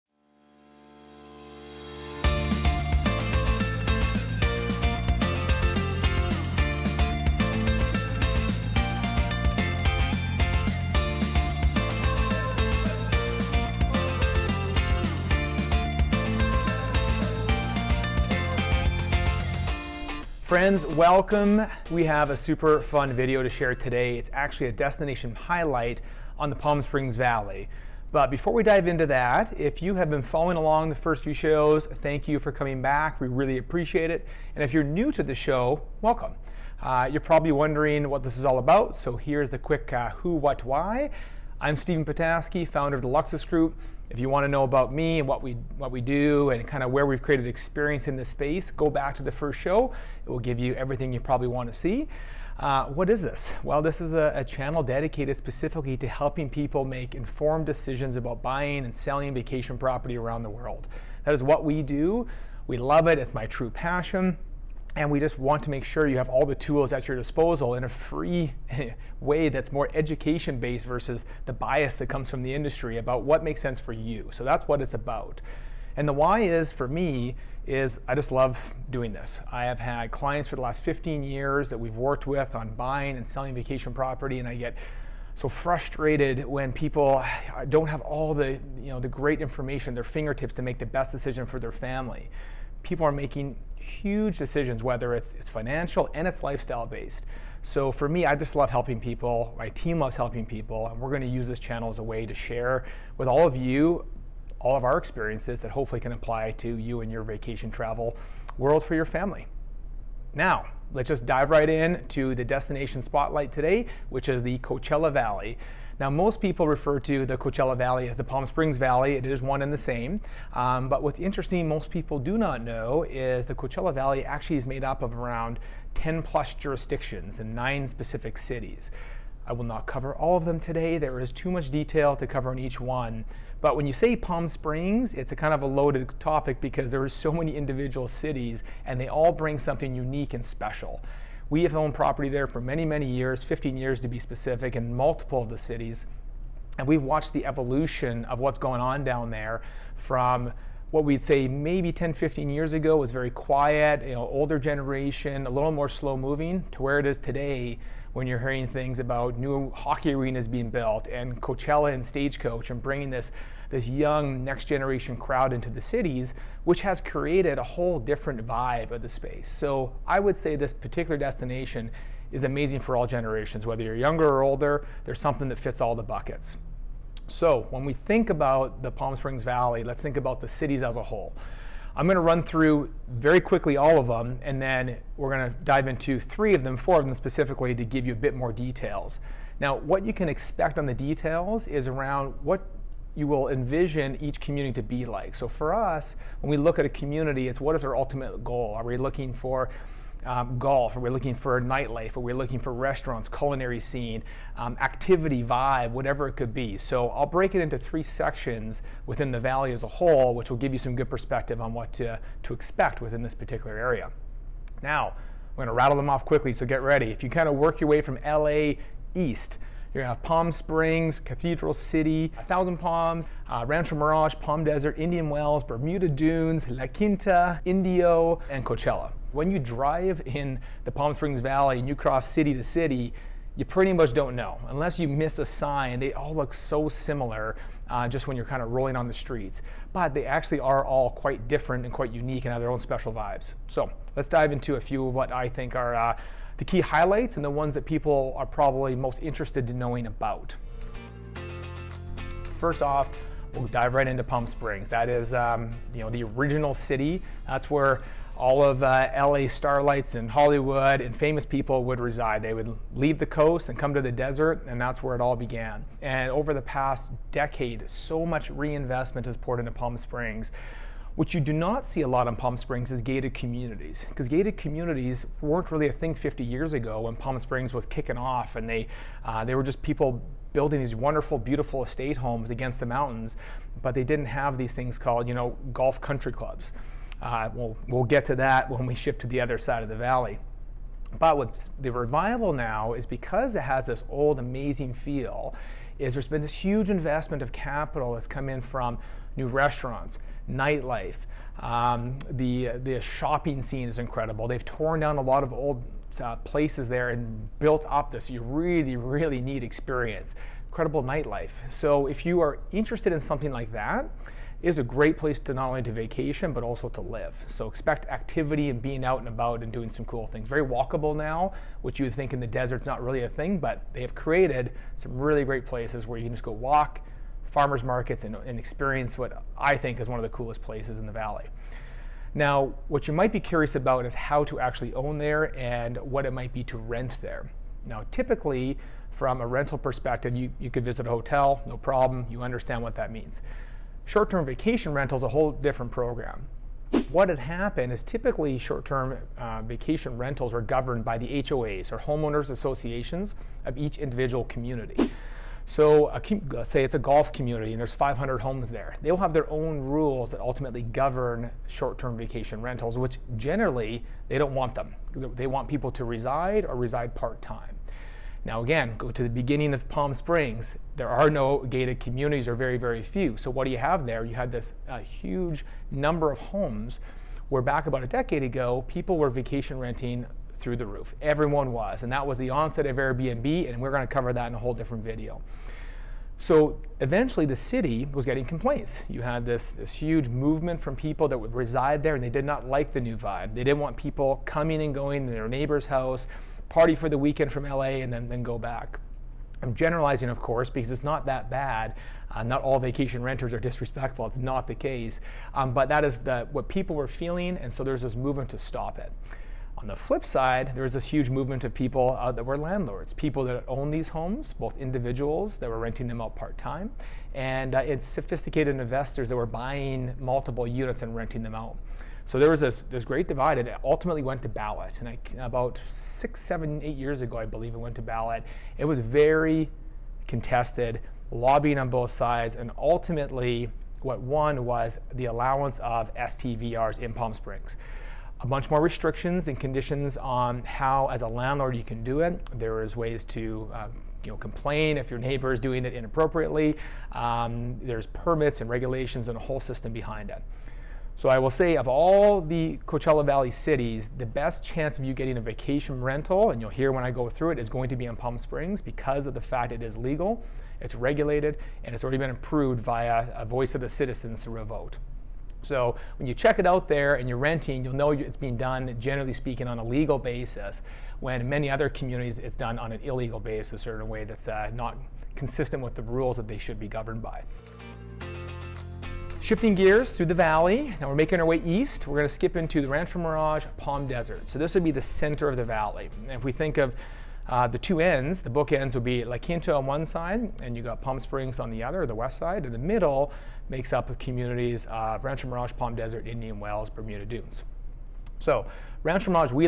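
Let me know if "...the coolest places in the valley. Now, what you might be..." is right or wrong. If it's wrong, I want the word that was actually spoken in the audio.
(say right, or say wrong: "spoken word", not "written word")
right.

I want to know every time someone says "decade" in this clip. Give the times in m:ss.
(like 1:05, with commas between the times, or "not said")
4:27, 6:18.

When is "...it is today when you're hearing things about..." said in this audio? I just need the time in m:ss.
2:36.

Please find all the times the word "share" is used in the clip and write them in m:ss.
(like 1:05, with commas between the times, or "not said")
0:23, 1:42.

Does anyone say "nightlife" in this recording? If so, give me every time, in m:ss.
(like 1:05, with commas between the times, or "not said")
3:21, 5:00, 5:11.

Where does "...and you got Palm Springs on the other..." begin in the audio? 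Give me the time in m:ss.
8:10.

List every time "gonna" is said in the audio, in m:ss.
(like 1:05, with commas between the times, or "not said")
3:40.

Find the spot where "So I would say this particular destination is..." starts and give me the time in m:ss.
2:49.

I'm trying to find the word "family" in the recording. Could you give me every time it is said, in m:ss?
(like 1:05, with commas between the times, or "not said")
1:31, 1:49.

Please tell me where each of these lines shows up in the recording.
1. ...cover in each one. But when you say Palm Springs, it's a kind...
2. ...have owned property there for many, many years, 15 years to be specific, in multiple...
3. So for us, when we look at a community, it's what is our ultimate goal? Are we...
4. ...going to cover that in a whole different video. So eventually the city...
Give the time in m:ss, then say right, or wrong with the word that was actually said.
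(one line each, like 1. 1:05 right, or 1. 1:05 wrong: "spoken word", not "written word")
1. 2:12 right
2. 2:21 right
3. 3:15 right
4. 6:23 right.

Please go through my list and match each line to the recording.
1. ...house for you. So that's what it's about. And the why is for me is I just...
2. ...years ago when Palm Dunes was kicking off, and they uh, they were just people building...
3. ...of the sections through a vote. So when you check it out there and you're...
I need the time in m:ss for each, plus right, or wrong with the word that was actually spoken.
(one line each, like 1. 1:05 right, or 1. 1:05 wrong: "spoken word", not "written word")
1. 1:13 wrong: "sense", not "house"
2. 4:36 wrong: "Springs", not "Dunes"
3. 7:43 wrong: "citizens", not "sections".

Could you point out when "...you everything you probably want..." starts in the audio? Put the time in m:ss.
0:50.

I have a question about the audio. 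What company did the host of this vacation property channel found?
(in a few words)
Luxus Group.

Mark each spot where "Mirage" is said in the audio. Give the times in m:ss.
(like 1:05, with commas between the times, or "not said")
3:43, 8:03, 8:15.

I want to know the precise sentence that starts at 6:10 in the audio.
There are no gated communities or very, very few.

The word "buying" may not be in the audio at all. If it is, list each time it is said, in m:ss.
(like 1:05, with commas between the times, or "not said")
0:58, 1:22, 6:59.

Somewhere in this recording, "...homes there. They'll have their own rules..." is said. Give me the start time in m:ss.
5:58.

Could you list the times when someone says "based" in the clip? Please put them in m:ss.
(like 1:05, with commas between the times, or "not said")
1:10, 1:36.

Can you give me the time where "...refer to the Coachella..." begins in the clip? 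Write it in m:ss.
1:56.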